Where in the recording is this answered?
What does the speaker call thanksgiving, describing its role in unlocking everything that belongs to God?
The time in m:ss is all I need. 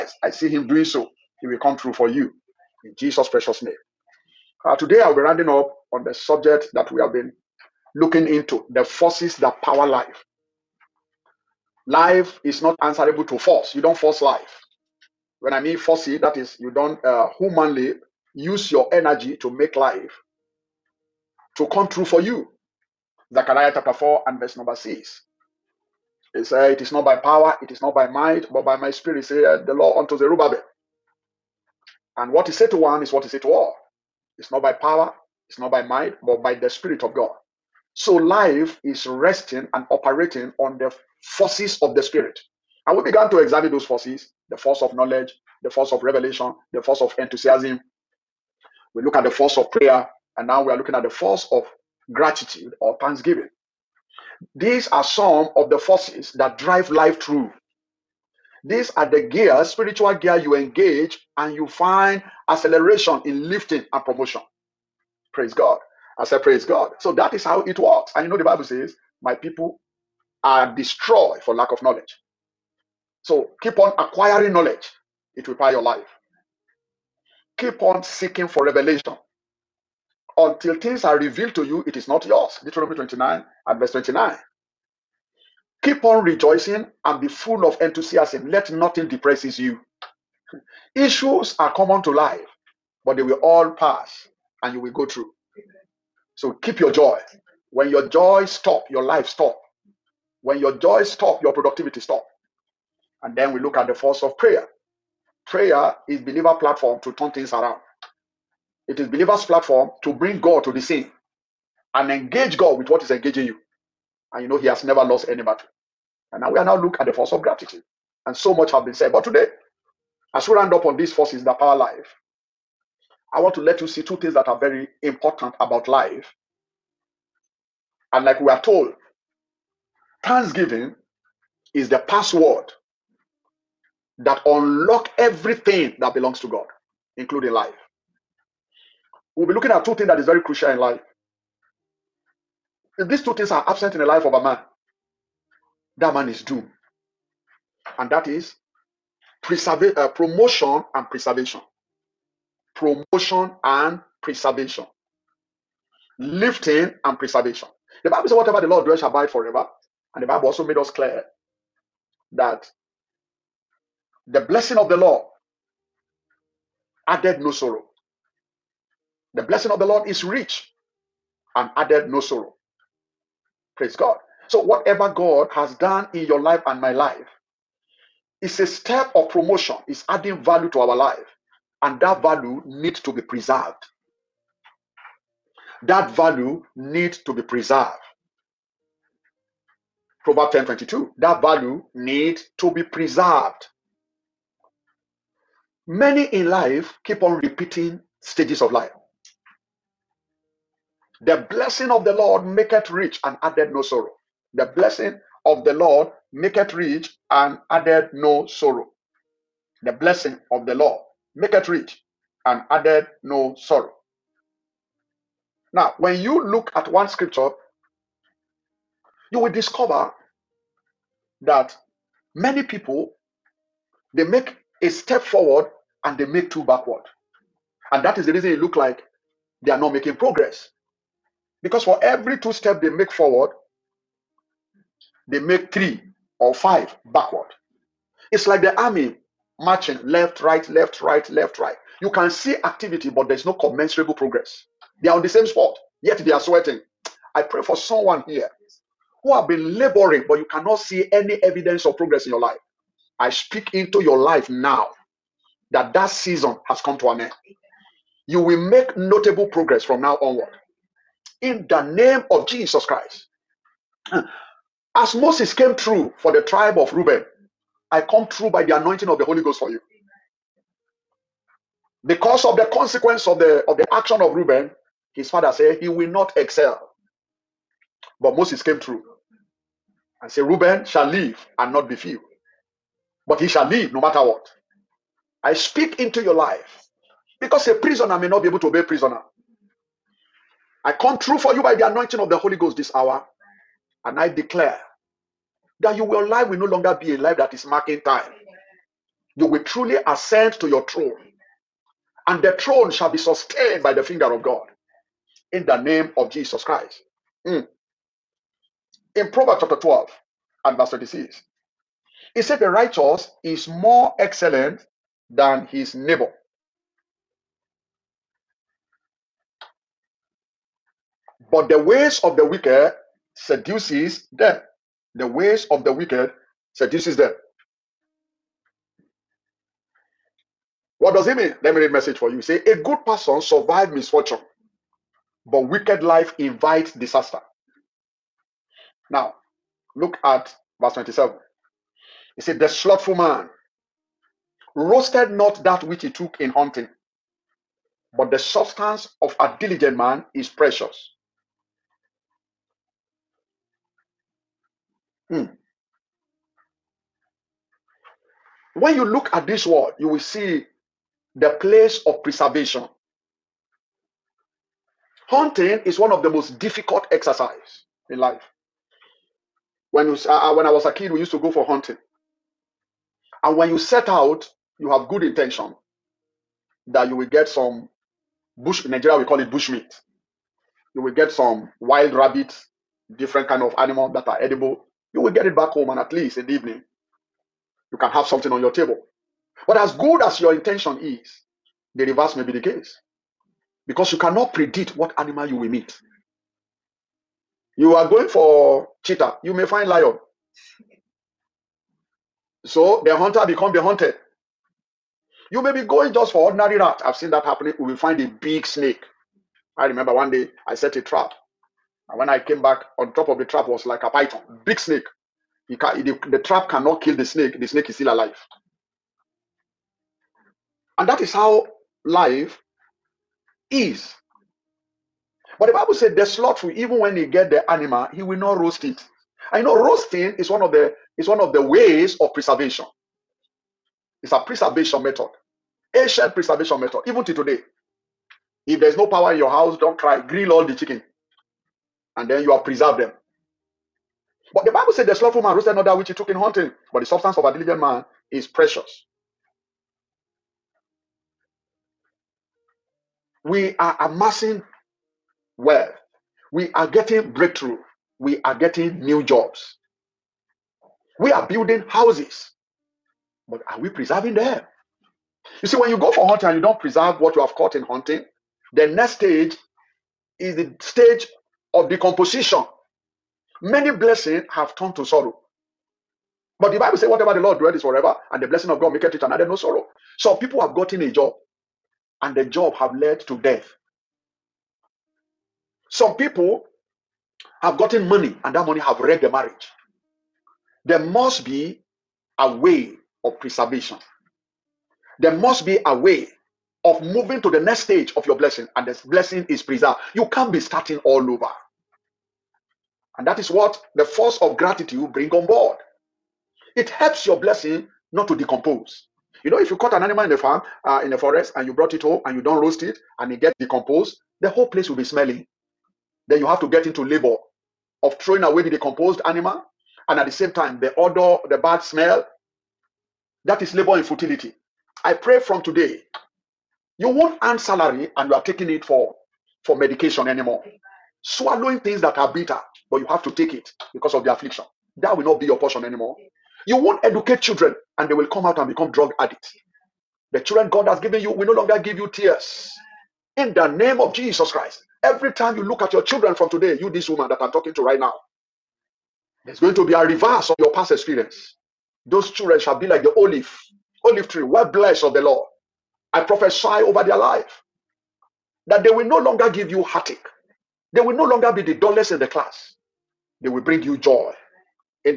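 2:11.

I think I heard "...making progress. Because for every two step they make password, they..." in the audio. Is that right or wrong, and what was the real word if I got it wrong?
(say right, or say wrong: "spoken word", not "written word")
wrong: "forward", not "password".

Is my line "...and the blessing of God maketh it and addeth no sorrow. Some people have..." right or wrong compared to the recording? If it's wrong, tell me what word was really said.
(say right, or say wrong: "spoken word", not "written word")
right.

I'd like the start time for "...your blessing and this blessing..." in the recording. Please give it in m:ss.
8:18.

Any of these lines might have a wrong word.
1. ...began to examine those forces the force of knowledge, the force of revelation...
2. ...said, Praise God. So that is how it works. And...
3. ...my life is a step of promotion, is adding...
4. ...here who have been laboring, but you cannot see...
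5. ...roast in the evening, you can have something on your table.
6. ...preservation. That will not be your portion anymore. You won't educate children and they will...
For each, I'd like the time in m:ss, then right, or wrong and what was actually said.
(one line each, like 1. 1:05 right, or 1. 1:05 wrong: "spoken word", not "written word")
1. 0:43 right
2. 1:06 right
3. 2:56 right
4. 4:08 right
5. 6:26 wrong: "least", not "roast"
6. 8:54 wrong: "affliction", not "preservation".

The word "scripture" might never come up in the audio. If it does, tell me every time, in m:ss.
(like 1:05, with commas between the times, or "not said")
3:37.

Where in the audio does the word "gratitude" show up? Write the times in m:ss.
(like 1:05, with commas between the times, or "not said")
0:52, 1:57, 8:24.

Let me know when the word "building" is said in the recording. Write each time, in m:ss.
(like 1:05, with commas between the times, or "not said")
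7:41.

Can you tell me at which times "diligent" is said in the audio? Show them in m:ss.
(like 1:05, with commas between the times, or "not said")
5:49, 7:27.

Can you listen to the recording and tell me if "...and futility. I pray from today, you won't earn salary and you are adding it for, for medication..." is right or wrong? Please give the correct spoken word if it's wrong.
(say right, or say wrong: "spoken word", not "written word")
wrong: "taking", not "adding".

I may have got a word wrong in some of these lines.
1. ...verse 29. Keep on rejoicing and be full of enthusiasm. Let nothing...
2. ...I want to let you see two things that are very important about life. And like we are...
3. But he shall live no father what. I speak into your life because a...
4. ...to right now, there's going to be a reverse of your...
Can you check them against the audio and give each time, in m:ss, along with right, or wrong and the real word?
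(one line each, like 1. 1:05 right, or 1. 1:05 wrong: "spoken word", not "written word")
1. 1:23 right
2. 2:03 right
3. 4:43 wrong: "matter", not "father"
4. 9:07 right.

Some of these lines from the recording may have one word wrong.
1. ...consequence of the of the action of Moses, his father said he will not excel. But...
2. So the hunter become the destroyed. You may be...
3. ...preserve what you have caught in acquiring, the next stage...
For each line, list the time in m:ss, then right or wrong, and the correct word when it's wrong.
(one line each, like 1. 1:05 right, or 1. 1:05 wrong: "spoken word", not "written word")
1. 4:32 wrong: "Reuben", not "Moses"
2. 6:42 wrong: "hunted", not "destroyed"
3. 7:46 wrong: "hunting", not "acquiring".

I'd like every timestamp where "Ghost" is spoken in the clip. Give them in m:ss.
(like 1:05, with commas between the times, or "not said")
4:29, 4:52.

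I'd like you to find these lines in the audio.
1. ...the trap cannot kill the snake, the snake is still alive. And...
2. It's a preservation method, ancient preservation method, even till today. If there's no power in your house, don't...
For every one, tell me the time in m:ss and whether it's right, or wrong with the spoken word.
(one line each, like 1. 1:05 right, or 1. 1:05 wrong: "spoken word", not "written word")
1. 6:56 right
2. 7:14 right.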